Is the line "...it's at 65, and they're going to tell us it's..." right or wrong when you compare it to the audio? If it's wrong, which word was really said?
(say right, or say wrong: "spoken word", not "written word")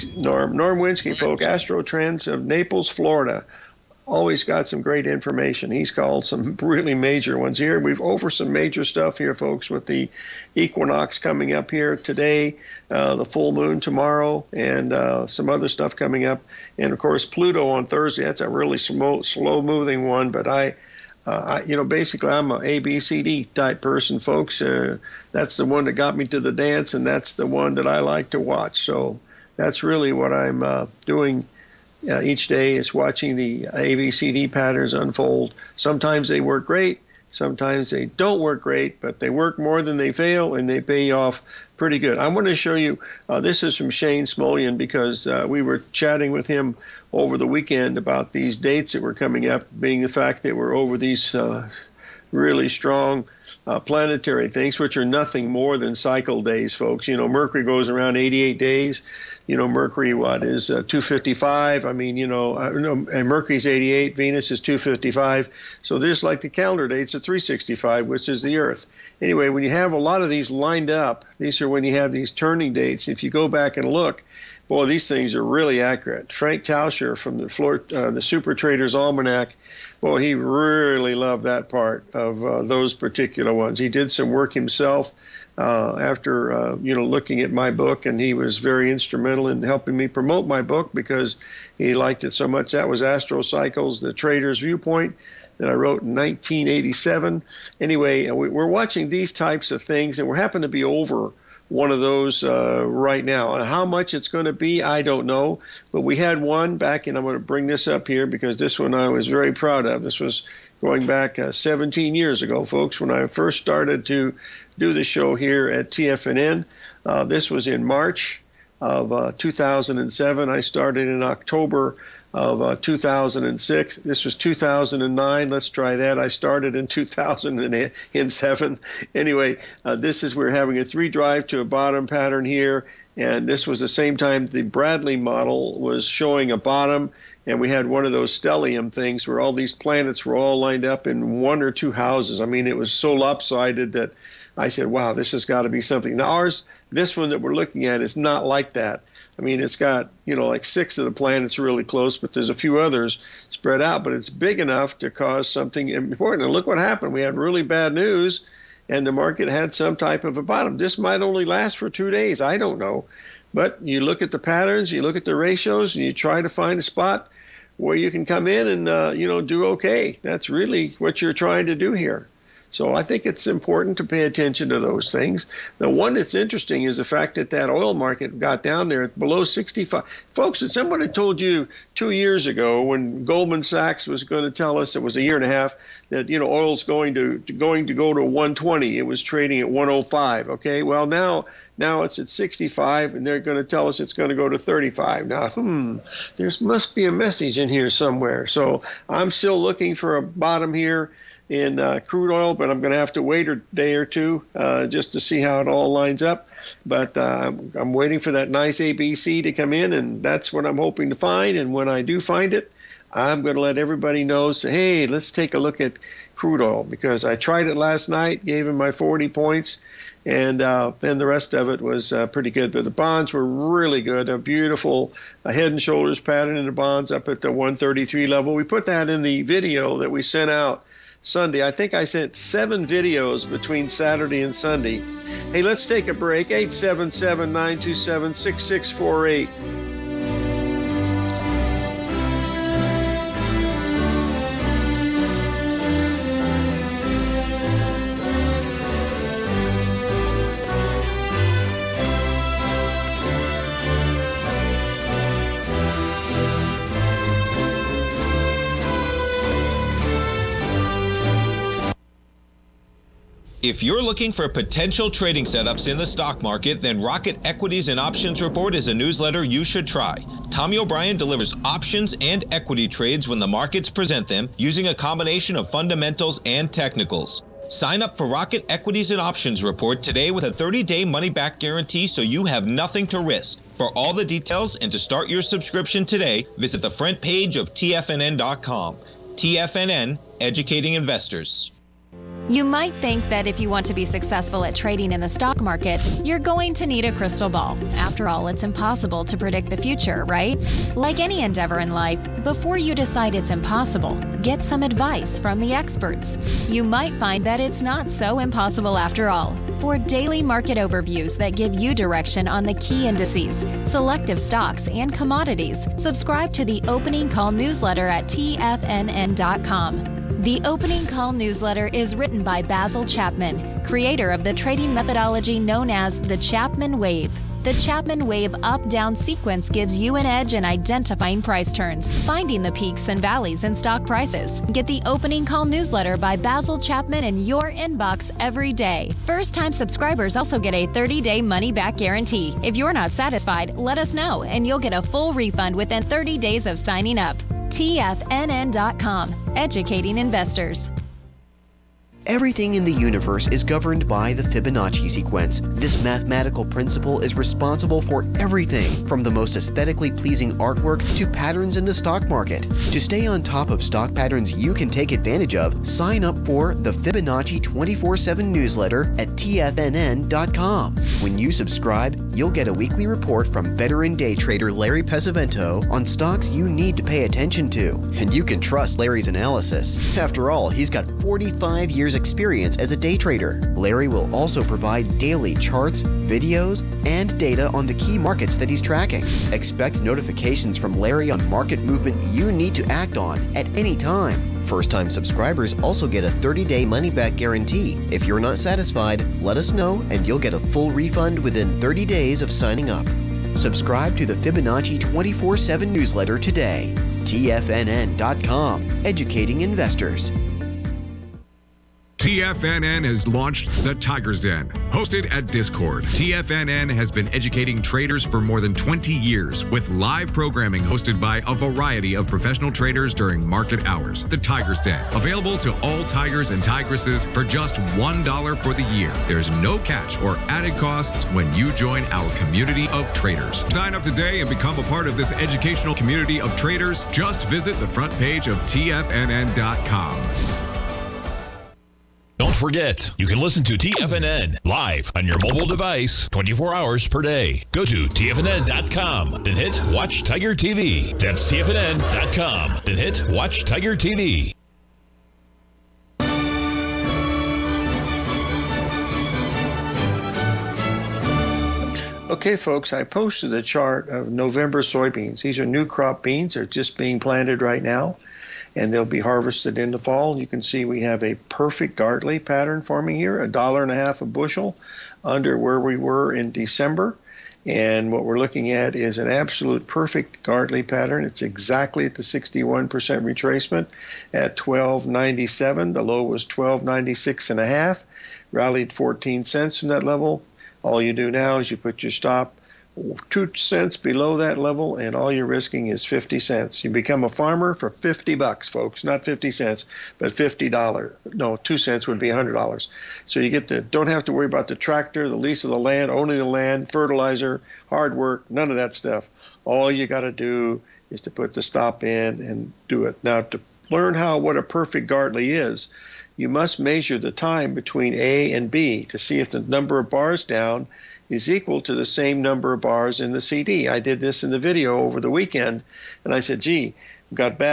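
right.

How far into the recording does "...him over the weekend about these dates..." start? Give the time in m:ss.
0:46.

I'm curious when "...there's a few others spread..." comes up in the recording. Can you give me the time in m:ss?
2:32.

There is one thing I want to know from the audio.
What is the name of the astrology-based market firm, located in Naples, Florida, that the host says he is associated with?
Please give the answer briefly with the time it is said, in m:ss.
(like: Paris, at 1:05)
Astro Trends, at 0:01.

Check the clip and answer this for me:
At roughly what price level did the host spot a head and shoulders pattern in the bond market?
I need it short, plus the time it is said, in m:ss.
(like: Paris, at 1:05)
133, at 3:47.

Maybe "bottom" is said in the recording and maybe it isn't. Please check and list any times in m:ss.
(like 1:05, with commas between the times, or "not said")
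2:11, 2:16, 2:40, 3:20.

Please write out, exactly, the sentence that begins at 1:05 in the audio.
So there's like the calendar dates at 365, which is the Earth.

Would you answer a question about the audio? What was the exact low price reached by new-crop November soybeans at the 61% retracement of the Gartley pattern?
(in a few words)
1296.5.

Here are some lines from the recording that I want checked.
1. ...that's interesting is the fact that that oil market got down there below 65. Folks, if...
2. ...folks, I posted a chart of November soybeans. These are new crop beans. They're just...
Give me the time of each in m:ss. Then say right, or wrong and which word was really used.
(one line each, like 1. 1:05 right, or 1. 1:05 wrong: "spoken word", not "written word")
1. 2:56 right
2. 7:42 right.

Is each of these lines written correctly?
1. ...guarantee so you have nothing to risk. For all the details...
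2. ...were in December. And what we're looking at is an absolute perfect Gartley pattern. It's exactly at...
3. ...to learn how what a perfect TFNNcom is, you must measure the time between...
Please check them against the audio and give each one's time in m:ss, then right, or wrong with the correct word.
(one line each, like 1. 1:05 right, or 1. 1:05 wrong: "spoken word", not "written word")
1. 4:41 right
2. 7:55 right
3. 8:33 wrong: "Gartley", not "TFNNcom".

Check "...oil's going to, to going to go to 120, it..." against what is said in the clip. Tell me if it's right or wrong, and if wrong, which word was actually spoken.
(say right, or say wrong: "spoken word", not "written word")
right.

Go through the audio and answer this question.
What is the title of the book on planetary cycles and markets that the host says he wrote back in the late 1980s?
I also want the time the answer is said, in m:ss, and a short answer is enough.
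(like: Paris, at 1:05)
Astro Cycles: The Trader's Viewpoint, at 1:33.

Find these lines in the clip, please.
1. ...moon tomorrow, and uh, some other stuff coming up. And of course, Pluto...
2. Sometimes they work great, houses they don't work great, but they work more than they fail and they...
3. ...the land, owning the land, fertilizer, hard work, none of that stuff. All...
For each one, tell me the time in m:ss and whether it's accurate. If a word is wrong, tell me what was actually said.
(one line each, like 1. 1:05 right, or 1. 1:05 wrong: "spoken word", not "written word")
1. 0:13 right
2. 0:35 wrong: "sometimes", not "houses"
3. 8:25 right.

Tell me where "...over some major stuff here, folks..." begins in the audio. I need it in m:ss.
0:08.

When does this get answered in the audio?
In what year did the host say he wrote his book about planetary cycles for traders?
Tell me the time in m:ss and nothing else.
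1:36.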